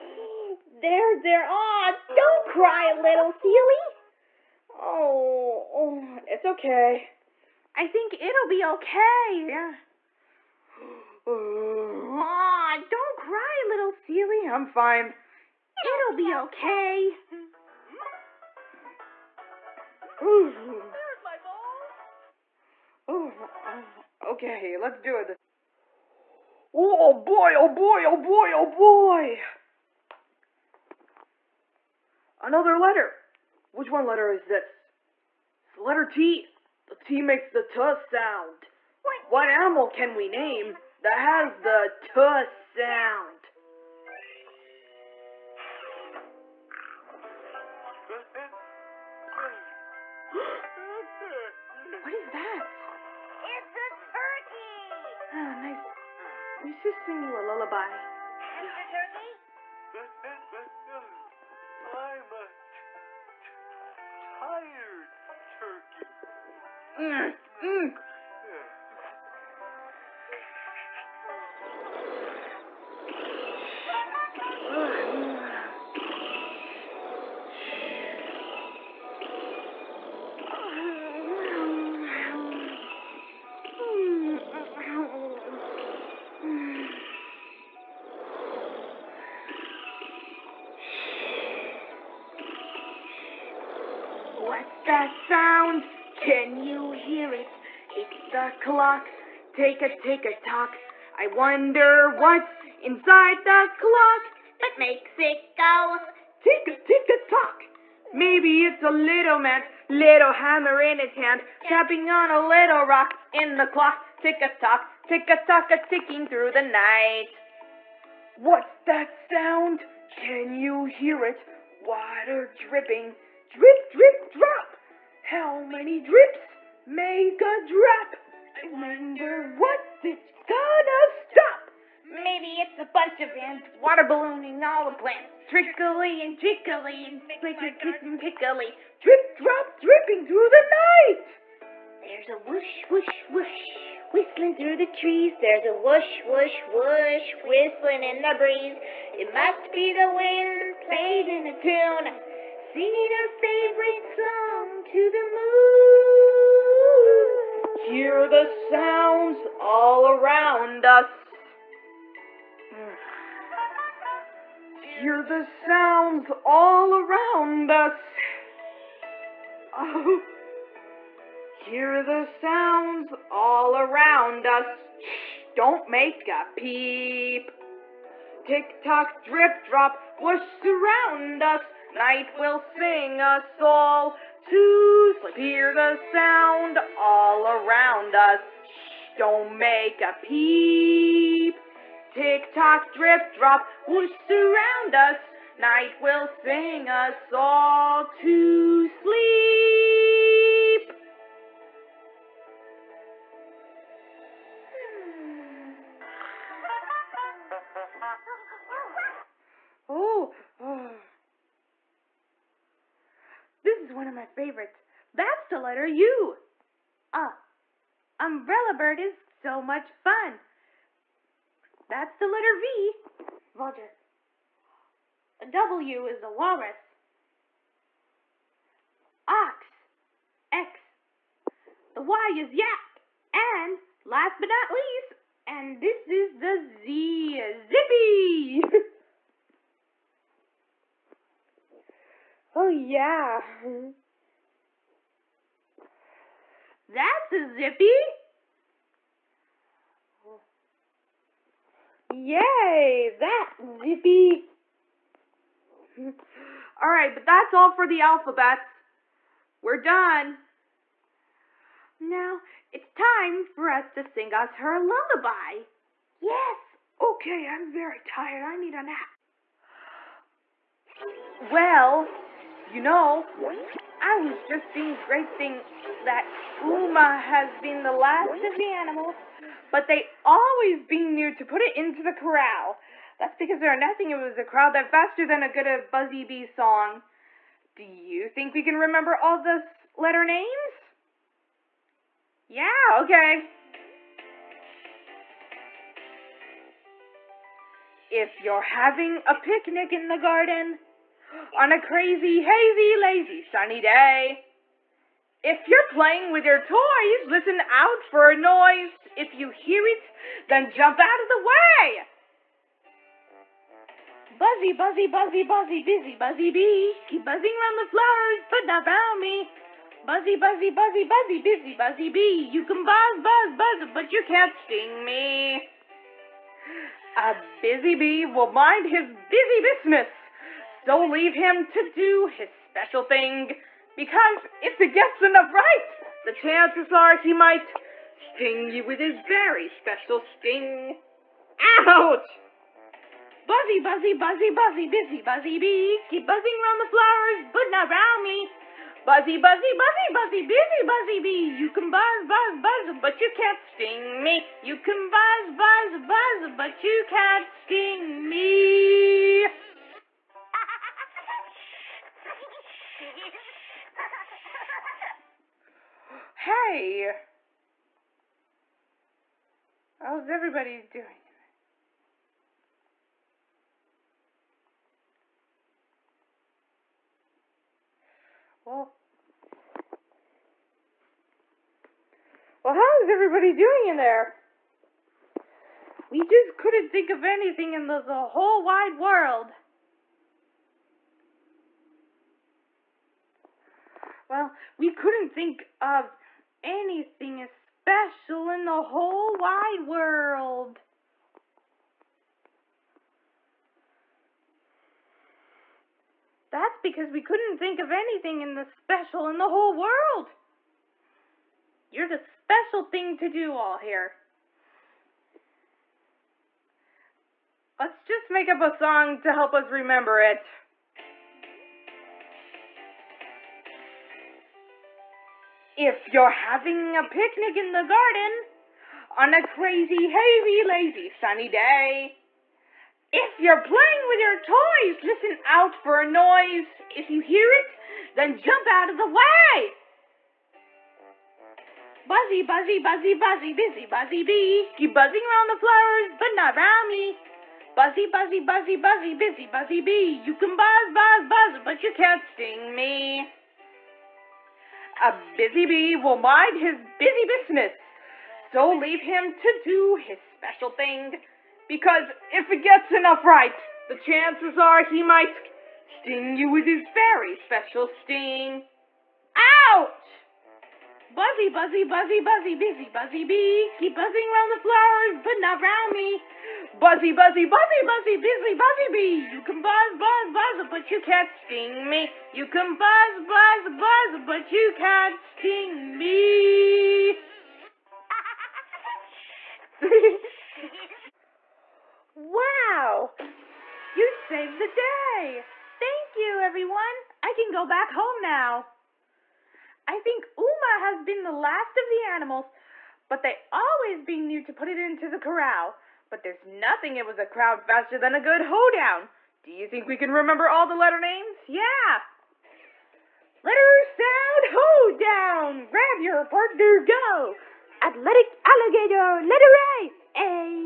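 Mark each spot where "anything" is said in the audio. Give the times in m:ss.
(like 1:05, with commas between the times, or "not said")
6:27, 6:36, 6:47.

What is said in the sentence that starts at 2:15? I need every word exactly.
Trickly and trickly and pickly, pickly.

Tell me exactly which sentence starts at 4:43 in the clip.
That's because there are nothing it was a crowd that faster than a good a Buzzy Bee song.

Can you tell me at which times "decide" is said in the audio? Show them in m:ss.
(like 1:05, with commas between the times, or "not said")
not said.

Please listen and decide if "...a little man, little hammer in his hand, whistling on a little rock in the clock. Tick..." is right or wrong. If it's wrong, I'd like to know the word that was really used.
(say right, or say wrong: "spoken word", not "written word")
wrong: "tapping", not "whistling".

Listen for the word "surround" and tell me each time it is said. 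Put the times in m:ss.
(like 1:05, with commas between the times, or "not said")
3:00, 3:14.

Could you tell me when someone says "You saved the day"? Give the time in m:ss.
8:13.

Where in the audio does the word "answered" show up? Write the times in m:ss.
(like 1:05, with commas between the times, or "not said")
not said.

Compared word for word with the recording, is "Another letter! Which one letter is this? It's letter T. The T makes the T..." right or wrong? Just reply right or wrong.
right.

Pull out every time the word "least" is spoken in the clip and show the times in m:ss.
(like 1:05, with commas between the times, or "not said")
3:54.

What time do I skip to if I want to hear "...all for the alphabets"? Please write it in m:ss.
4:17.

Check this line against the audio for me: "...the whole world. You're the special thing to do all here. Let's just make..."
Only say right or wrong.
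right.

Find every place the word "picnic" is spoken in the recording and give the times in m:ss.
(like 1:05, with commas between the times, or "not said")
4:59, 7:07.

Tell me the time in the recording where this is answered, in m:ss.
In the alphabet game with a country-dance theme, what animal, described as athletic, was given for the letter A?
8:38.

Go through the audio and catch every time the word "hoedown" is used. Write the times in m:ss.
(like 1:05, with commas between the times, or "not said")
8:28, 8:34.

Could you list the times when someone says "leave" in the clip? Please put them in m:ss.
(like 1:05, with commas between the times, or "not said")
5:31, 7:38.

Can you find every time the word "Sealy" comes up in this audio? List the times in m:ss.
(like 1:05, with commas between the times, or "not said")
0:03, 0:13.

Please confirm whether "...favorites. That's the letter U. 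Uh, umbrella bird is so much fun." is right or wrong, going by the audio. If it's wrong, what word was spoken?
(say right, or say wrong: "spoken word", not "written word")
right.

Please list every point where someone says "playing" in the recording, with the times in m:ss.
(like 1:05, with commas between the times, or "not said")
2:30, 5:05, 7:13.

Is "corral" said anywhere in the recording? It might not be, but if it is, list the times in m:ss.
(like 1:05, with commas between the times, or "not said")
4:42, 8:25.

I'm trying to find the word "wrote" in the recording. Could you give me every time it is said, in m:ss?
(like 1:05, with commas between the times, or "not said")
not said.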